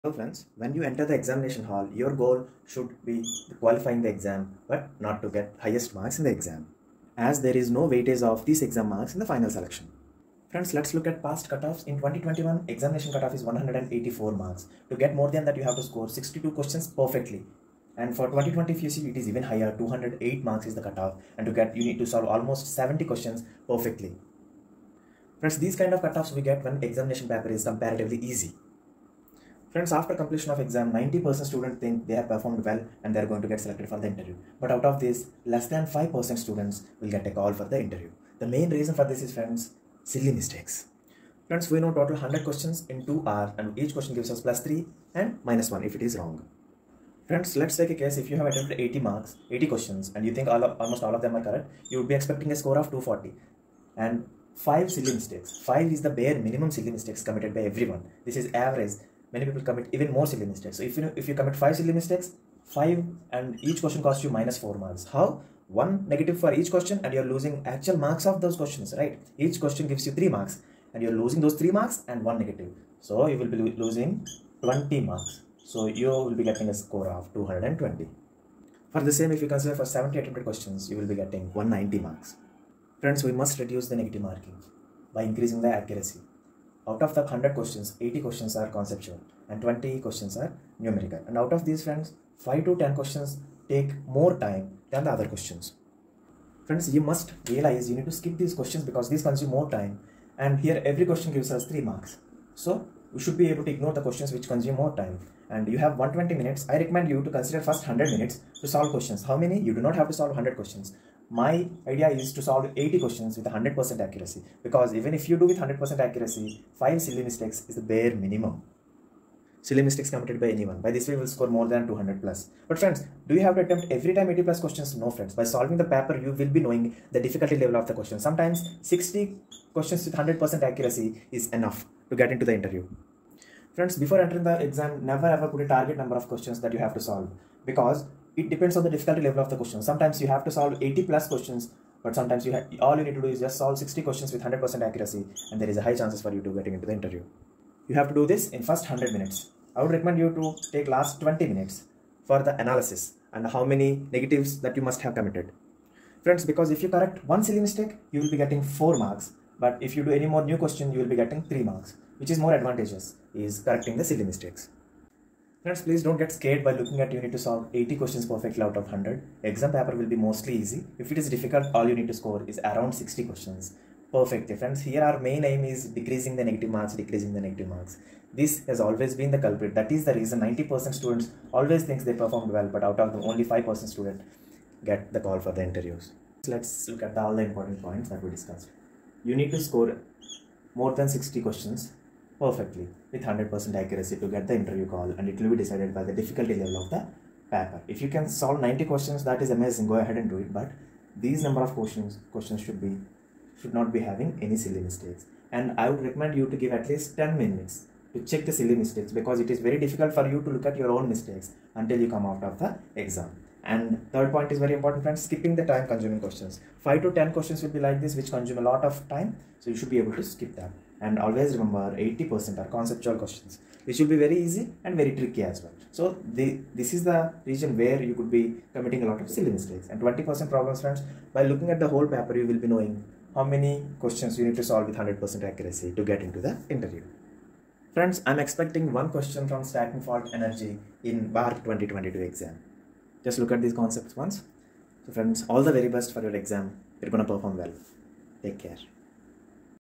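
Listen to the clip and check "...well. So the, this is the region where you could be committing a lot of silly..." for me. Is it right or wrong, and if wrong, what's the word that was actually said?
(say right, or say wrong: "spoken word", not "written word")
right.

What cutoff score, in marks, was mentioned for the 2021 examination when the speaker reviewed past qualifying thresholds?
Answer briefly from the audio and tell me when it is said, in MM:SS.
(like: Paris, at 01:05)
184, at 00:13.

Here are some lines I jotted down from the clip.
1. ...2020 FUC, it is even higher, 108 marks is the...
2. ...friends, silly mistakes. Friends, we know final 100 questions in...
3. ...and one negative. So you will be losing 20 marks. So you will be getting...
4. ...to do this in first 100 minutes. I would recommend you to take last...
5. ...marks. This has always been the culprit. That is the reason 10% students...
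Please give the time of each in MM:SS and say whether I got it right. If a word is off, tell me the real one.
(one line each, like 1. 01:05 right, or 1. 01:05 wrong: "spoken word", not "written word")
1. 00:18 wrong: "208", not "108"
2. 00:39 wrong: "total", not "final"
3. 01:12 right
4. 02:28 right
5. 02:57 wrong: "90", not "10".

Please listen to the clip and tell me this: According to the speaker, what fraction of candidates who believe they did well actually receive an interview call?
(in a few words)
less than 5%.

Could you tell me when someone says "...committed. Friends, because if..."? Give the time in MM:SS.
02:35.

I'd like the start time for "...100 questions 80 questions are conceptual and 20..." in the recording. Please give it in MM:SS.
01:27.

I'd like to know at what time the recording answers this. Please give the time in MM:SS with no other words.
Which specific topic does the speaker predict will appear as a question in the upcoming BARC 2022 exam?
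03:59.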